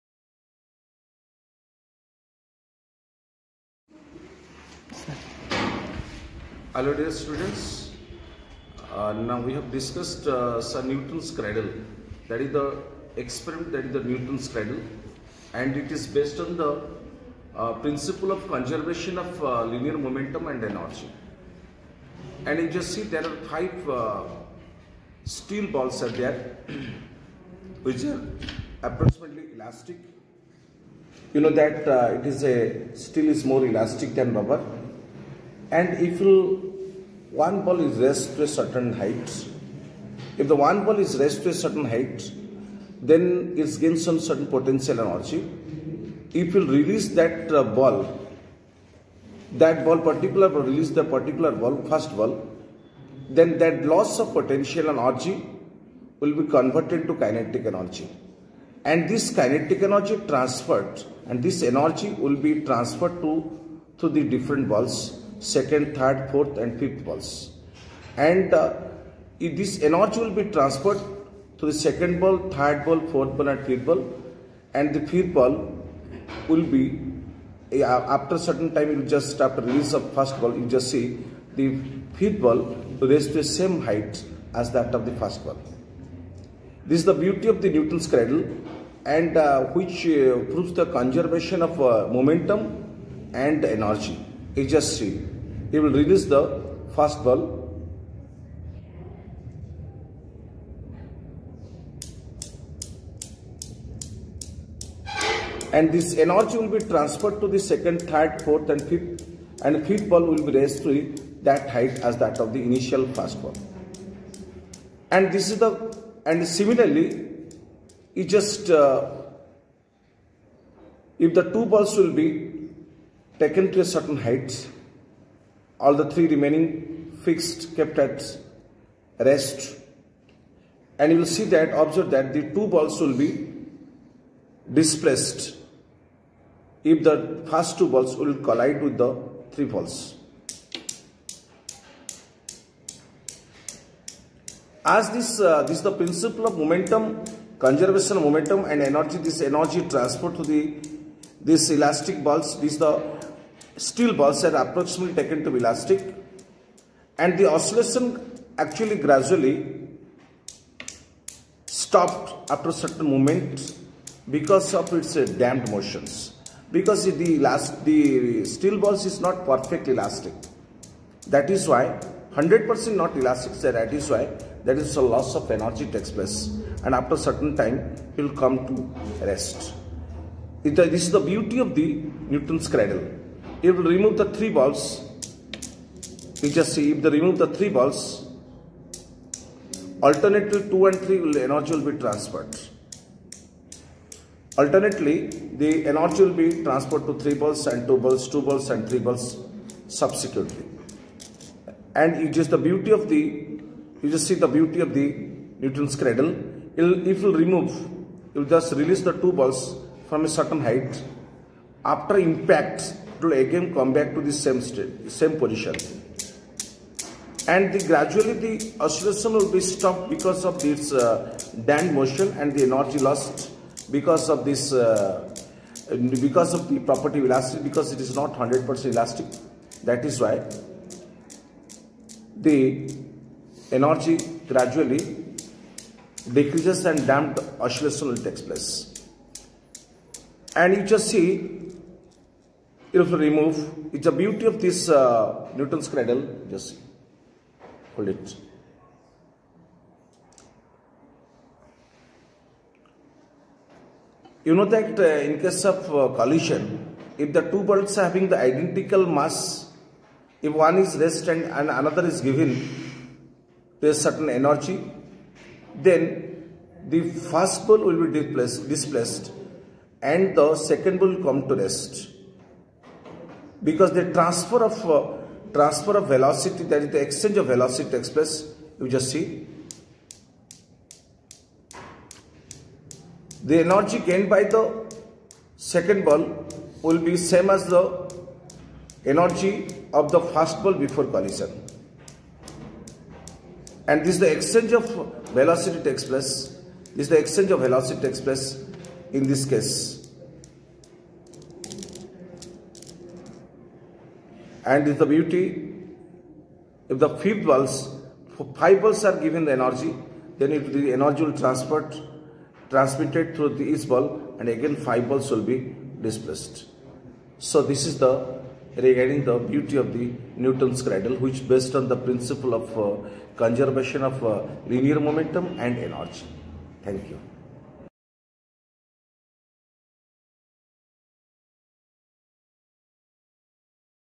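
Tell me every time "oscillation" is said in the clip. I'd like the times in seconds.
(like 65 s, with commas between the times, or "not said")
157 s, 218 s, 237 s.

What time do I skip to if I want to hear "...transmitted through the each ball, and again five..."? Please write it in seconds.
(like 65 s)
312 s.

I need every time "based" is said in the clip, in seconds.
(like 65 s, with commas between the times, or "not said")
16 s, 321 s.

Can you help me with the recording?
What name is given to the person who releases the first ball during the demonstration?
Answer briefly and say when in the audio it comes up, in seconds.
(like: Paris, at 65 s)
Ejasri, at 94 s.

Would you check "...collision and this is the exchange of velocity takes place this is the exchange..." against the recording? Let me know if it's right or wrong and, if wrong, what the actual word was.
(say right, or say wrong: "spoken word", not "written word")
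right.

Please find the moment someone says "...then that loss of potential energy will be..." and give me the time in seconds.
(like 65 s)
53 s.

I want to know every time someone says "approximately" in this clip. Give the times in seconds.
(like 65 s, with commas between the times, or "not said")
28 s, 154 s.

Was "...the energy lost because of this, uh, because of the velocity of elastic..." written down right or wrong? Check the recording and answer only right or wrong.
wrong.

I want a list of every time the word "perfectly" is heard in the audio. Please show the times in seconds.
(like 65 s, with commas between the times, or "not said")
169 s.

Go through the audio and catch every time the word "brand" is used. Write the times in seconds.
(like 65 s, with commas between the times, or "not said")
not said.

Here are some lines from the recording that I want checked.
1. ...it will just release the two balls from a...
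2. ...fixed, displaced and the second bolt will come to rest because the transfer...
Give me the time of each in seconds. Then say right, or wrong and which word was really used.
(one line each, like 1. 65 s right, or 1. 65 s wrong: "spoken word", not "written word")
1. 208 s right
2. 268 s wrong: "displaced", not "fixed".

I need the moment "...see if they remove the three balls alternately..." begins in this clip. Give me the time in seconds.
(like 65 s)
186 s.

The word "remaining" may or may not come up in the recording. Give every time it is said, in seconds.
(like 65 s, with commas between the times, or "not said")
126 s.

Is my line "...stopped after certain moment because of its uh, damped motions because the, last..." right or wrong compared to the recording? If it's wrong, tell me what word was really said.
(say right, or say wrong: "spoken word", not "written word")
right.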